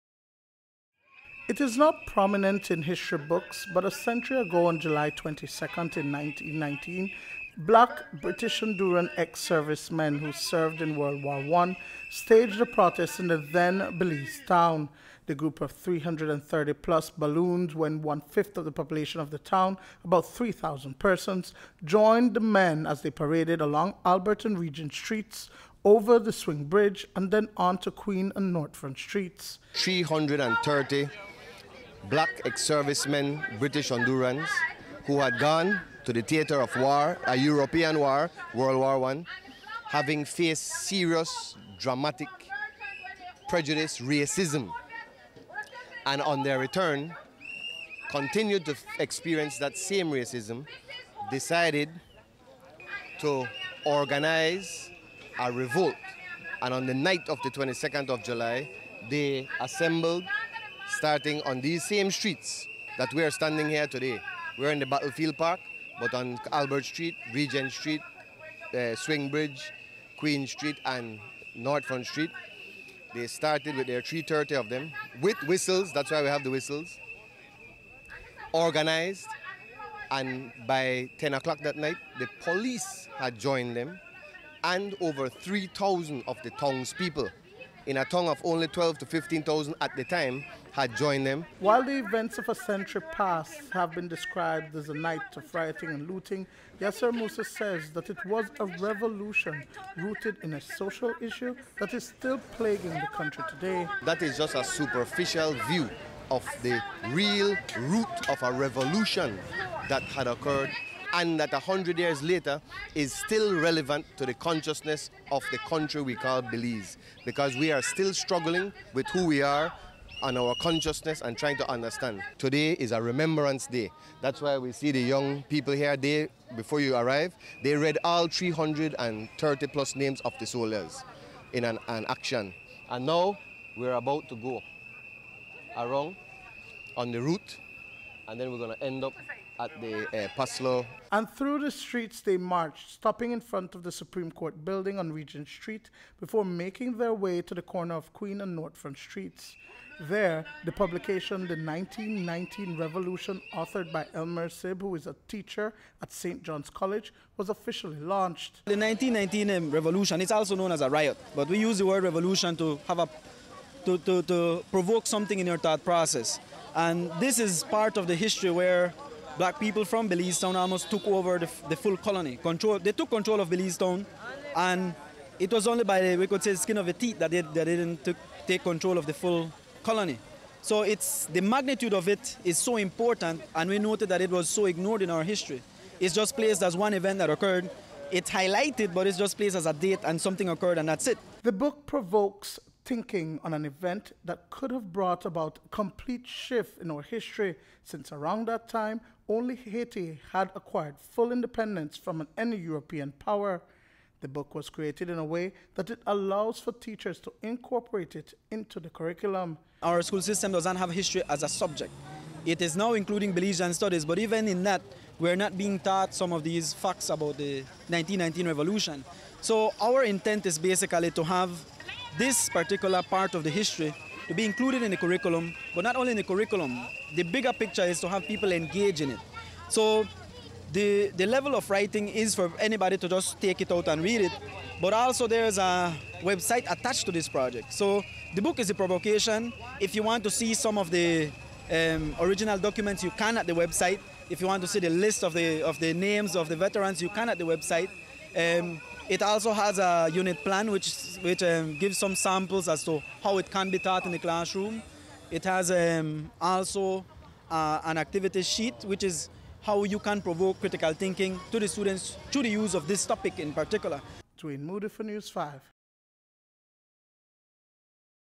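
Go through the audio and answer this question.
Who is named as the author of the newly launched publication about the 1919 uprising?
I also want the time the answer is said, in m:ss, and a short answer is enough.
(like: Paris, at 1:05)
Elmer Sib, at 2:34.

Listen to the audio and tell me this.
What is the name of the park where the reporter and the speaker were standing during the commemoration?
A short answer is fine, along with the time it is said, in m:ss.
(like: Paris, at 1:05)
Battlefield Park, at 1:04.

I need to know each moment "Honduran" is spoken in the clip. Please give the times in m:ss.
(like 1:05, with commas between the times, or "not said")
0:08, 0:33.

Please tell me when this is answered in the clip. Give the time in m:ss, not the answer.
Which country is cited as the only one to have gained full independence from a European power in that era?
3:19.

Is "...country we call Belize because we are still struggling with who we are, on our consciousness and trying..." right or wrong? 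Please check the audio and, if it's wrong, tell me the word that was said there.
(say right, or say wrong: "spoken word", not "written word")
right.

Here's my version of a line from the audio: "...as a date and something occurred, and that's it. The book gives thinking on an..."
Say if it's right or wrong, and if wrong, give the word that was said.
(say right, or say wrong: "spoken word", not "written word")
wrong: "provokes", not "gives".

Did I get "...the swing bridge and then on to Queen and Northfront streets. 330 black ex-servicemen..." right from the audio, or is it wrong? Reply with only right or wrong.
right.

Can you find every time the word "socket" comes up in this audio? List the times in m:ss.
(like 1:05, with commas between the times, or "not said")
not said.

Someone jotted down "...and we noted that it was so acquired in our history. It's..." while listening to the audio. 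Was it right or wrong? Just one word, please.
wrong.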